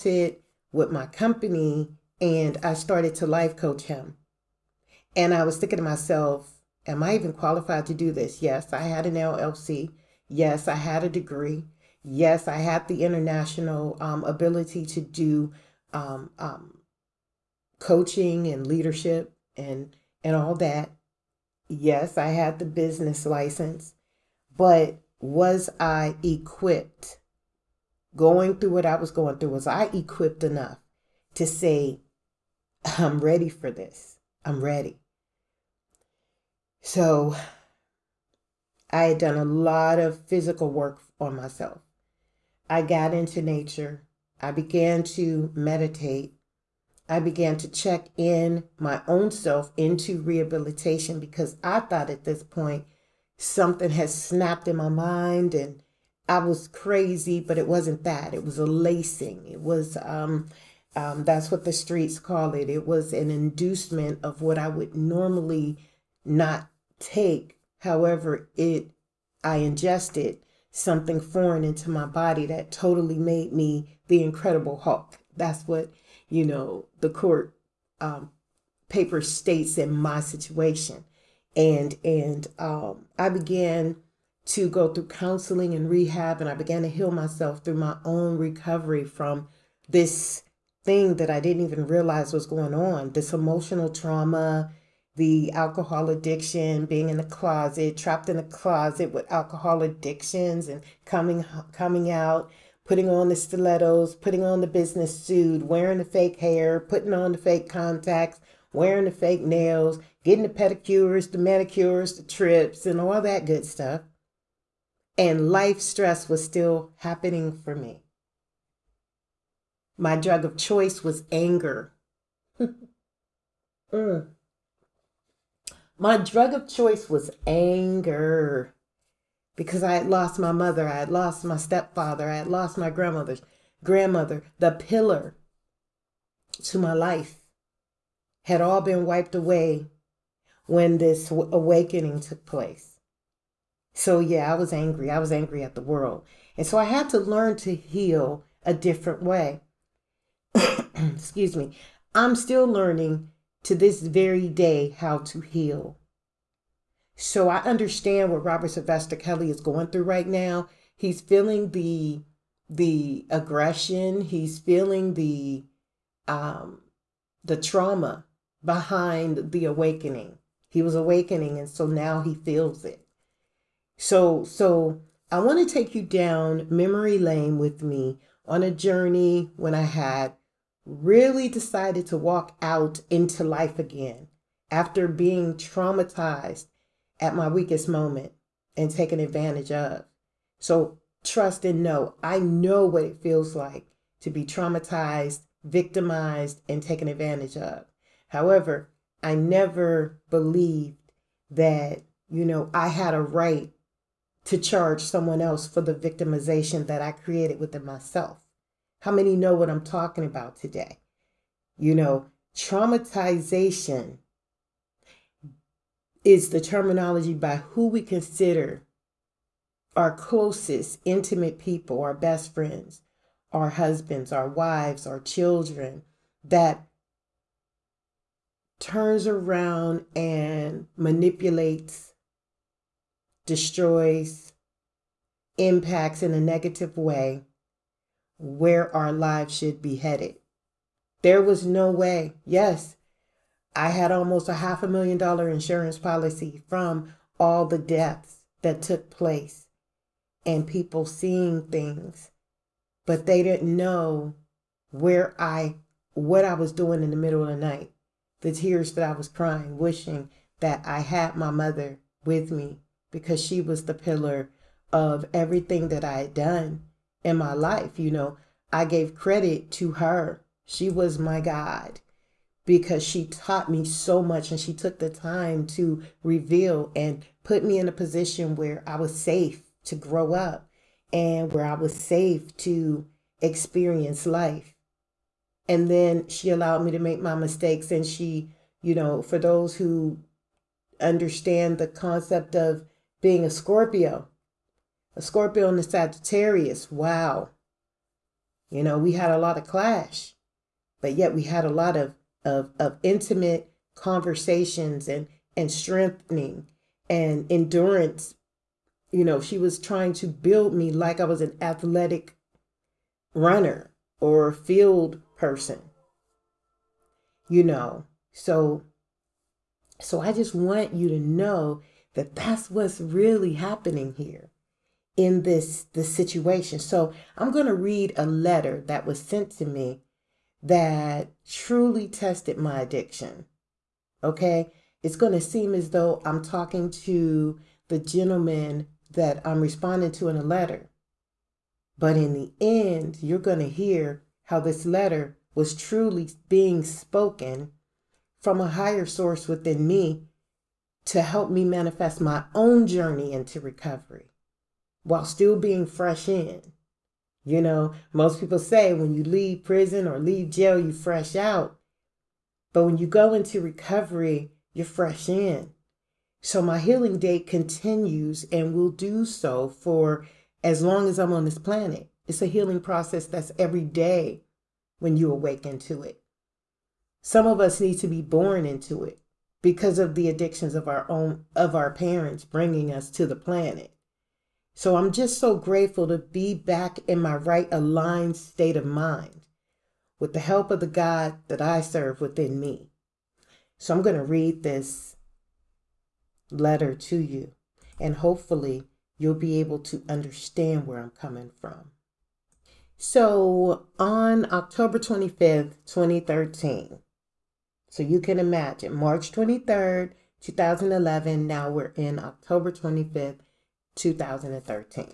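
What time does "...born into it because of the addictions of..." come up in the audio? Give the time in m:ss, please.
6:18.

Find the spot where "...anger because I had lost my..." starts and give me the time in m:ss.
2:07.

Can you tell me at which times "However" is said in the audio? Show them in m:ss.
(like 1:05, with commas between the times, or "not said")
1:07, 3:18.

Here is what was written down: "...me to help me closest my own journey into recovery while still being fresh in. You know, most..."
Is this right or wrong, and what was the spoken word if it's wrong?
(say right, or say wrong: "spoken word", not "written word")
wrong: "manifest", not "closest".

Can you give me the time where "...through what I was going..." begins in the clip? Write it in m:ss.
0:28.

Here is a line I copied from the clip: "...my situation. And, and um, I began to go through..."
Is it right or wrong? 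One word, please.
right.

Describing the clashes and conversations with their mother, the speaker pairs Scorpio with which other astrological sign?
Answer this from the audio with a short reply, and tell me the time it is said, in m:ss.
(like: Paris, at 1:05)
Sagittarius, at 4:55.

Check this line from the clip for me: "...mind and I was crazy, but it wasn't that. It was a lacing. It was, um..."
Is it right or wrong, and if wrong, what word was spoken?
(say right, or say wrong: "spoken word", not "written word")
right.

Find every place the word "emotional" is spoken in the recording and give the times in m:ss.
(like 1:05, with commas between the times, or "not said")
1:33.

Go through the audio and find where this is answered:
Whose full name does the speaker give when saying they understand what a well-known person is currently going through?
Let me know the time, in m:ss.
2:38.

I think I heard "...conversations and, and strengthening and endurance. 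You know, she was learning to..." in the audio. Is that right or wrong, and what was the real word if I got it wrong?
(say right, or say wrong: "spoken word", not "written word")
wrong: "trying", not "learning".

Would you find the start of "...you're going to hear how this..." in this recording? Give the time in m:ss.
5:43.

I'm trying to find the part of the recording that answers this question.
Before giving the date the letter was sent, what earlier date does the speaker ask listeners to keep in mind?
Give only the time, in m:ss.
6:48.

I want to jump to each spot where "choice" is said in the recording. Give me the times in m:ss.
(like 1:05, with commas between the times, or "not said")
2:00, 2:06.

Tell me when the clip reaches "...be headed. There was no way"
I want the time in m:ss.
3:59.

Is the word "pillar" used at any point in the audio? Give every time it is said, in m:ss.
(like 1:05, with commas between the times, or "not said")
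2:14, 4:23.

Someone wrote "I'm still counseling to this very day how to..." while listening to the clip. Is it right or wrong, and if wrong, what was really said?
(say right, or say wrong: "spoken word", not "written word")
wrong: "learning", not "counseling".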